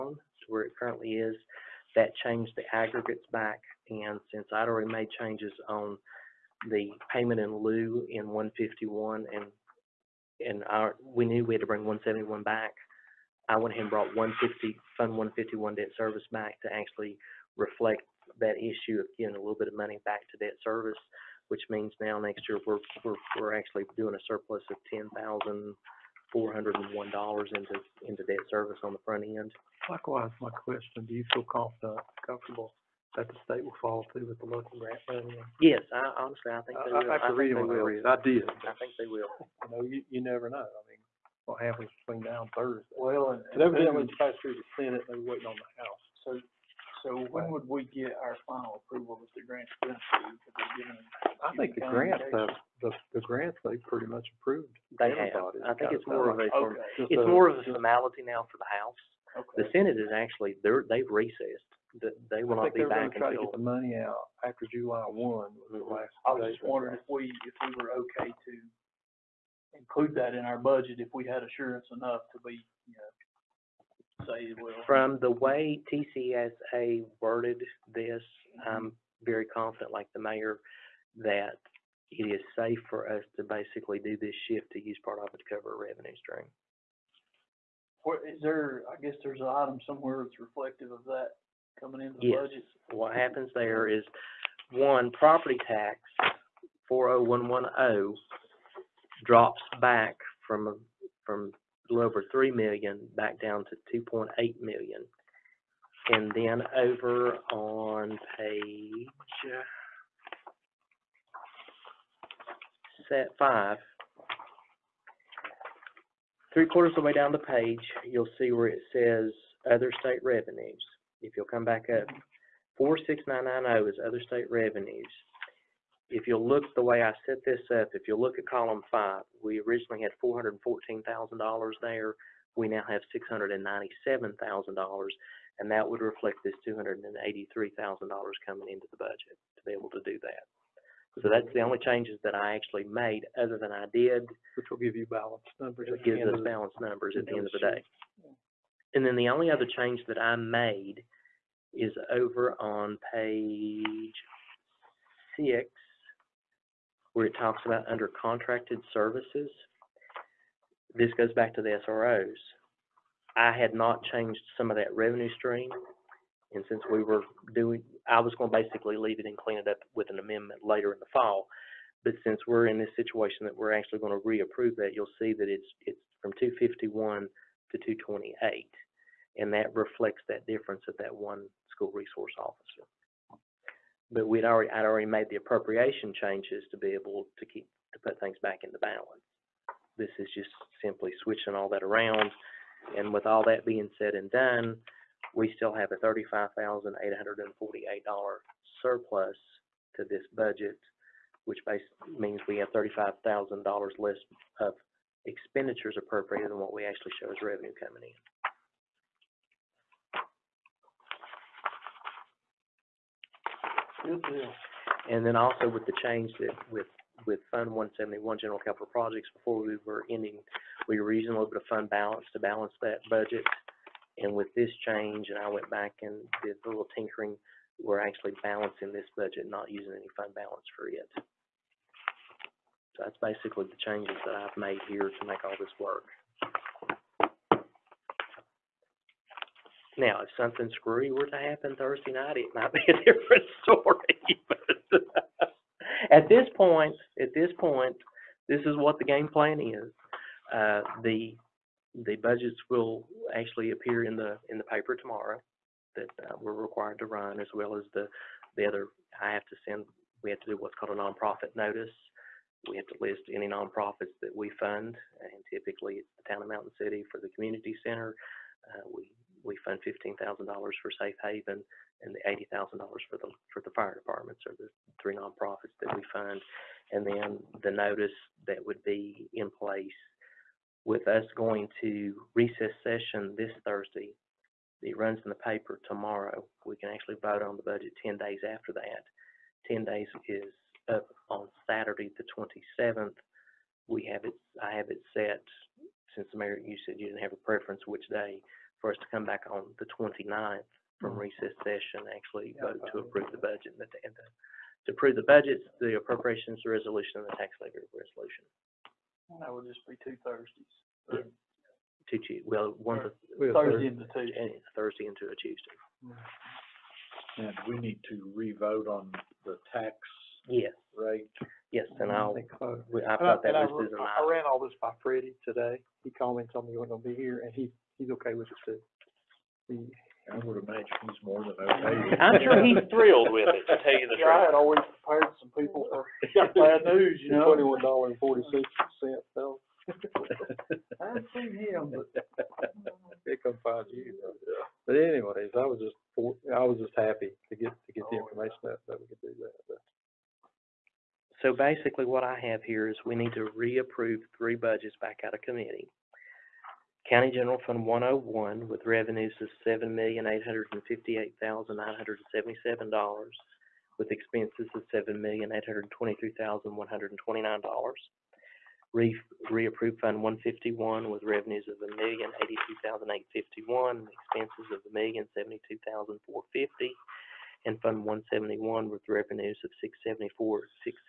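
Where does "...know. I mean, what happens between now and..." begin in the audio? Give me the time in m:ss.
0:40.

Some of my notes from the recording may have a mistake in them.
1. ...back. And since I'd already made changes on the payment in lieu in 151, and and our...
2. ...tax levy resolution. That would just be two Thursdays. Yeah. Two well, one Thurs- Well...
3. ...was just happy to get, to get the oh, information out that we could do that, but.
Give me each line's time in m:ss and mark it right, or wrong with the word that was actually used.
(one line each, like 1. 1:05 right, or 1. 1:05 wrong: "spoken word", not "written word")
1. 0:03 right
2. 5:07 right
3. 5:46 right.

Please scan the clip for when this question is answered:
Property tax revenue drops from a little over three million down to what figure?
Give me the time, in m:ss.
1:44.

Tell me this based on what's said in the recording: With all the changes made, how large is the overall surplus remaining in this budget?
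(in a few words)
$35,848.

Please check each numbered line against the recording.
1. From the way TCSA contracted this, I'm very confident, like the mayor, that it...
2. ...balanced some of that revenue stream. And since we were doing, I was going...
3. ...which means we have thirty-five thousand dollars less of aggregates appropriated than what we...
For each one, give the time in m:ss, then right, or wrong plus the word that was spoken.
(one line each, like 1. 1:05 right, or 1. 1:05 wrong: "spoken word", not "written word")
1. 1:14 wrong: "worded", not "contracted"
2. 2:44 wrong: "changed", not "balanced"
3. 3:21 wrong: "expenditures", not "aggregates".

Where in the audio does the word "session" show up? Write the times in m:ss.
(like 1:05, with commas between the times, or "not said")
4:42, 5:01.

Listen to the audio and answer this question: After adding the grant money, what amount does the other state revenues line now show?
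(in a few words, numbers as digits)
$697,000.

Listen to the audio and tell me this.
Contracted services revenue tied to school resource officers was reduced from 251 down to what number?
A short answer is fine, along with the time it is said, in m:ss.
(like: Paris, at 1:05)
228, at 2:57.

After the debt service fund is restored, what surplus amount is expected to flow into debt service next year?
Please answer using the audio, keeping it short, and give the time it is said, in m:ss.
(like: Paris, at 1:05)
$10,401, at 0:24.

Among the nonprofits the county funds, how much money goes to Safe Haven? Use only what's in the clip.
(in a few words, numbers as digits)
$15,000.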